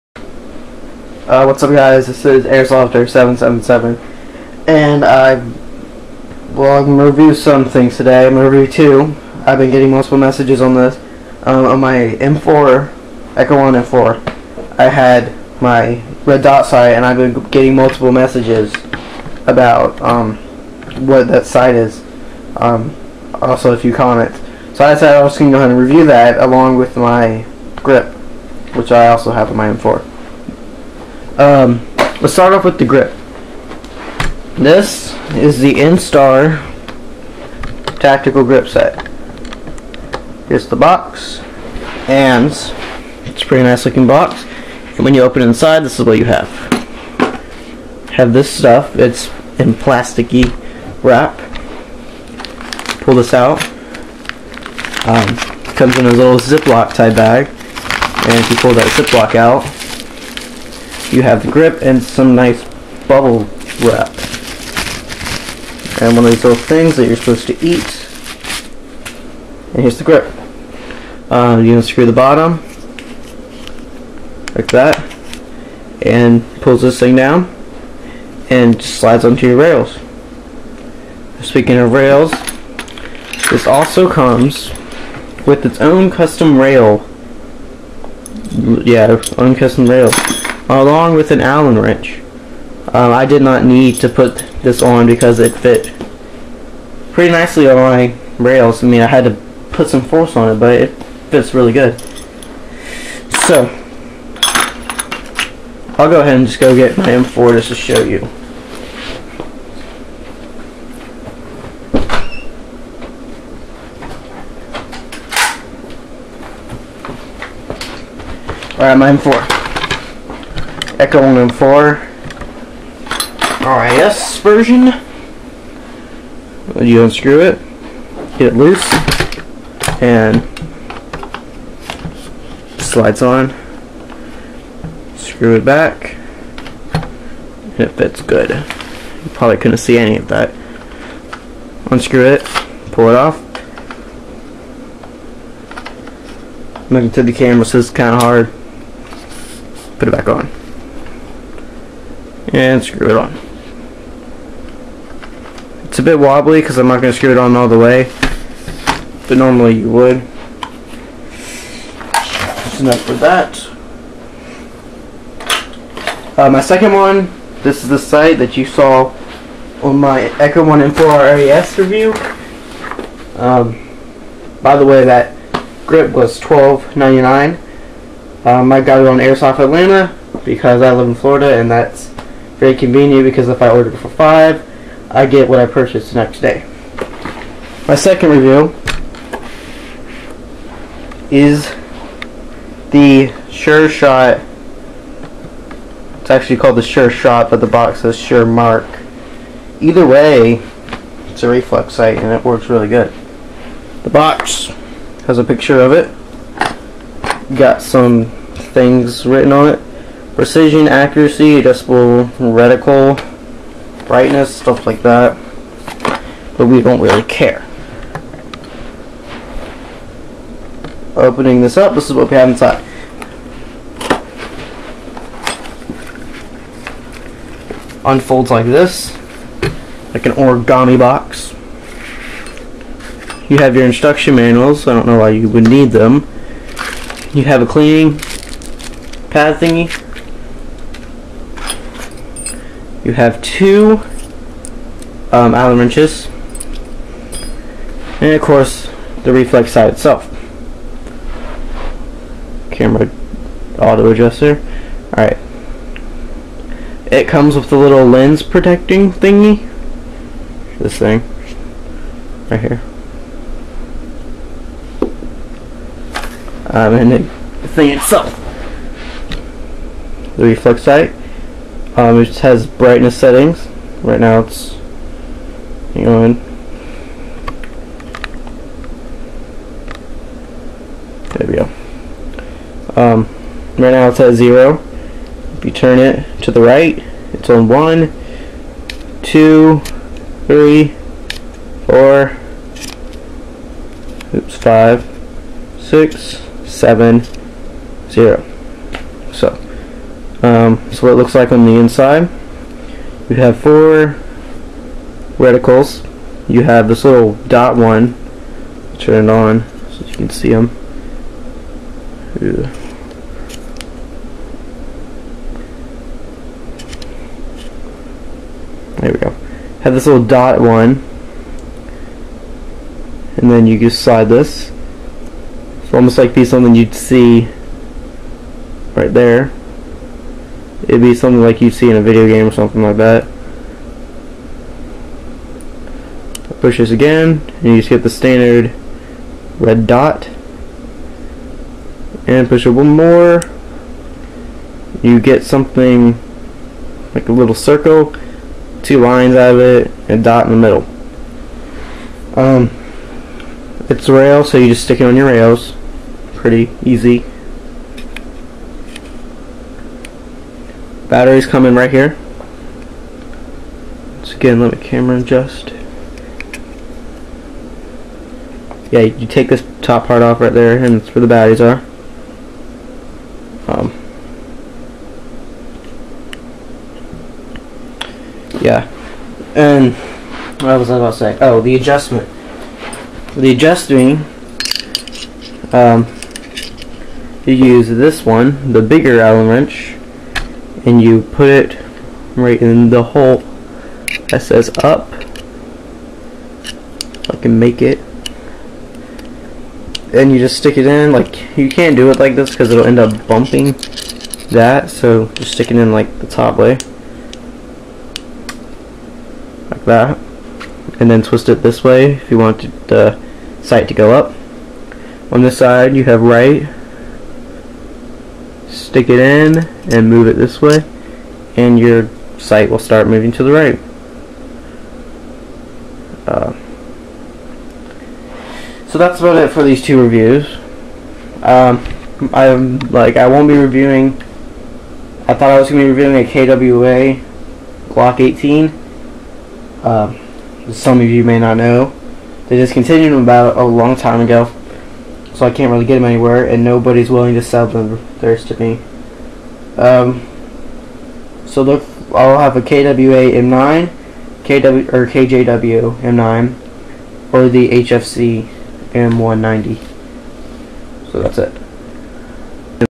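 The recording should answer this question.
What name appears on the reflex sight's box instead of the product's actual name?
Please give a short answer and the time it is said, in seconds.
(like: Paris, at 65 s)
Sure Mark, at 198 s.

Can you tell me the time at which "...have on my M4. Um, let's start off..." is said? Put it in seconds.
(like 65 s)
29 s.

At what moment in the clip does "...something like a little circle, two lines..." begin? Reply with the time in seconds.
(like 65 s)
345 s.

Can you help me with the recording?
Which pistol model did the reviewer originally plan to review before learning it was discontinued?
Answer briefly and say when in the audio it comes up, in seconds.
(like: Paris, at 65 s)
KWA Glock 18, at 436 s.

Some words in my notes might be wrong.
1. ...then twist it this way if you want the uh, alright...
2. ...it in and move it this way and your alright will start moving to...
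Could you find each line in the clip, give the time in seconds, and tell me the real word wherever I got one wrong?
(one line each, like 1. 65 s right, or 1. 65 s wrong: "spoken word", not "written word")
1. 411 s wrong: "sight", not "alright"
2. 419 s wrong: "sight", not "alright".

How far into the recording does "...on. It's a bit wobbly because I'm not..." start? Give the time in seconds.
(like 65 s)
153 s.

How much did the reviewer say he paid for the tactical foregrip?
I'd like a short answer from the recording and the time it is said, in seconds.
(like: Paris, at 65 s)
$12.99, at 176 s.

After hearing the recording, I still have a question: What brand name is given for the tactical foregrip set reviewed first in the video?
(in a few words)
Instar.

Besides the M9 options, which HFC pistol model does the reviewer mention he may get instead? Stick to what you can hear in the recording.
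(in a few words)
HFC M190.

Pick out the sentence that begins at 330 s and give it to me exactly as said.
It'd be something like you'd see in a video game or something like that.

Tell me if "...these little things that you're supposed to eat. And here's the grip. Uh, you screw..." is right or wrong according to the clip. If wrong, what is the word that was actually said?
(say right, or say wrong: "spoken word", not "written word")
wrong: "unscrew", not "screw".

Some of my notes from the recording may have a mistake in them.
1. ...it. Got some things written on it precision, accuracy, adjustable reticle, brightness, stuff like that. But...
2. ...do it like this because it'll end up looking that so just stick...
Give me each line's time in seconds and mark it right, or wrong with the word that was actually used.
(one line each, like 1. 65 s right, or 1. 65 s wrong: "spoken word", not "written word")
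1. 205 s right
2. 401 s wrong: "bumping", not "looking".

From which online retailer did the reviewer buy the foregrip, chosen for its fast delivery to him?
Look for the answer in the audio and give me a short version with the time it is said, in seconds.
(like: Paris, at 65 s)
Airsoft Atlanta, at 179 s.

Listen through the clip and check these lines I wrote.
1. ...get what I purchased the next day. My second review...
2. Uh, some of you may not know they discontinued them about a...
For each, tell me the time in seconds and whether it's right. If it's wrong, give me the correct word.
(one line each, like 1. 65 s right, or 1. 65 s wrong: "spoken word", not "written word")
1. 185 s right
2. 439 s right.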